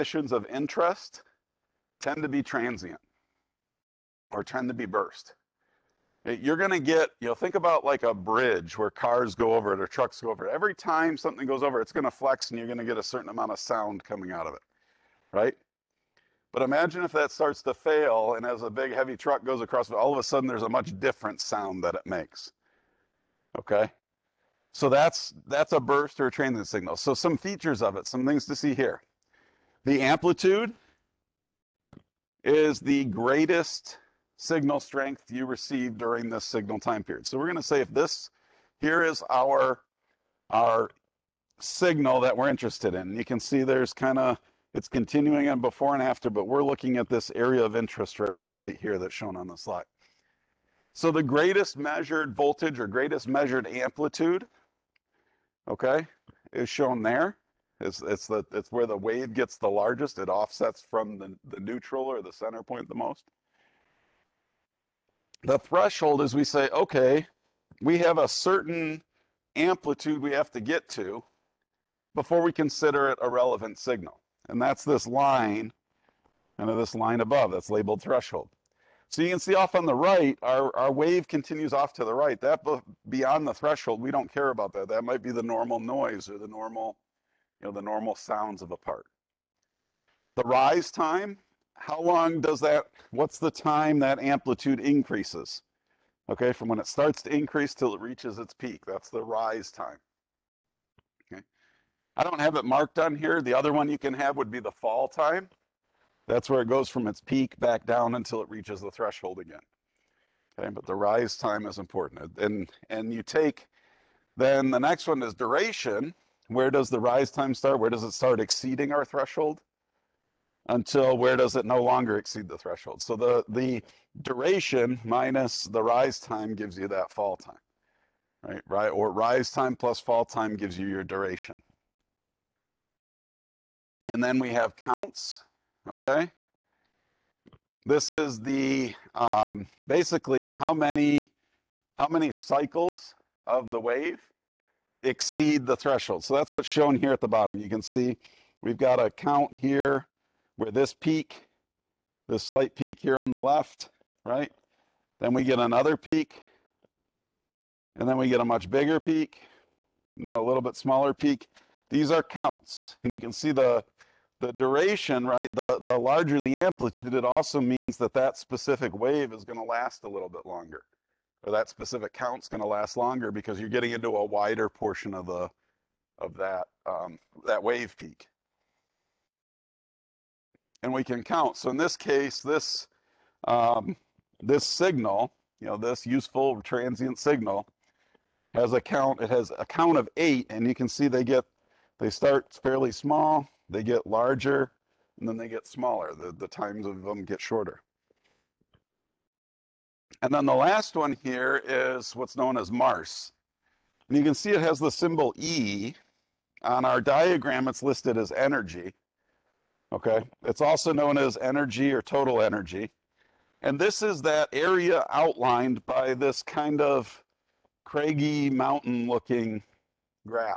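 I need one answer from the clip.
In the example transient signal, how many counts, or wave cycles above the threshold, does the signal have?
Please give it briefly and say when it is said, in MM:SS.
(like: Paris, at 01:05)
8, at 03:10.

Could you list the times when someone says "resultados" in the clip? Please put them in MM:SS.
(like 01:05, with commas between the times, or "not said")
not said.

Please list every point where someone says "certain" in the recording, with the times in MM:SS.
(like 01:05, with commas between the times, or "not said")
00:13, 01:08.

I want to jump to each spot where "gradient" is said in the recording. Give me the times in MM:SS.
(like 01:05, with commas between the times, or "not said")
not said.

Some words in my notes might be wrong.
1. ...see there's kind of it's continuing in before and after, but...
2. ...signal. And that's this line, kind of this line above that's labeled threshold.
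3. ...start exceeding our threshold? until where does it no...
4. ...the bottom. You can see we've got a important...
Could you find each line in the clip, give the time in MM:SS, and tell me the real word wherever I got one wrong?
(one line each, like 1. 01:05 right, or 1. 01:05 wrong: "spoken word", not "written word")
1. 00:43 right
2. 01:13 right
3. 01:58 right
4. 02:27 wrong: "count", not "important".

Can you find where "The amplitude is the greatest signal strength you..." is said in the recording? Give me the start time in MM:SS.
00:29.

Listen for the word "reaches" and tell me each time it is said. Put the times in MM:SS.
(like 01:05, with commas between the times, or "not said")
01:38, 01:48.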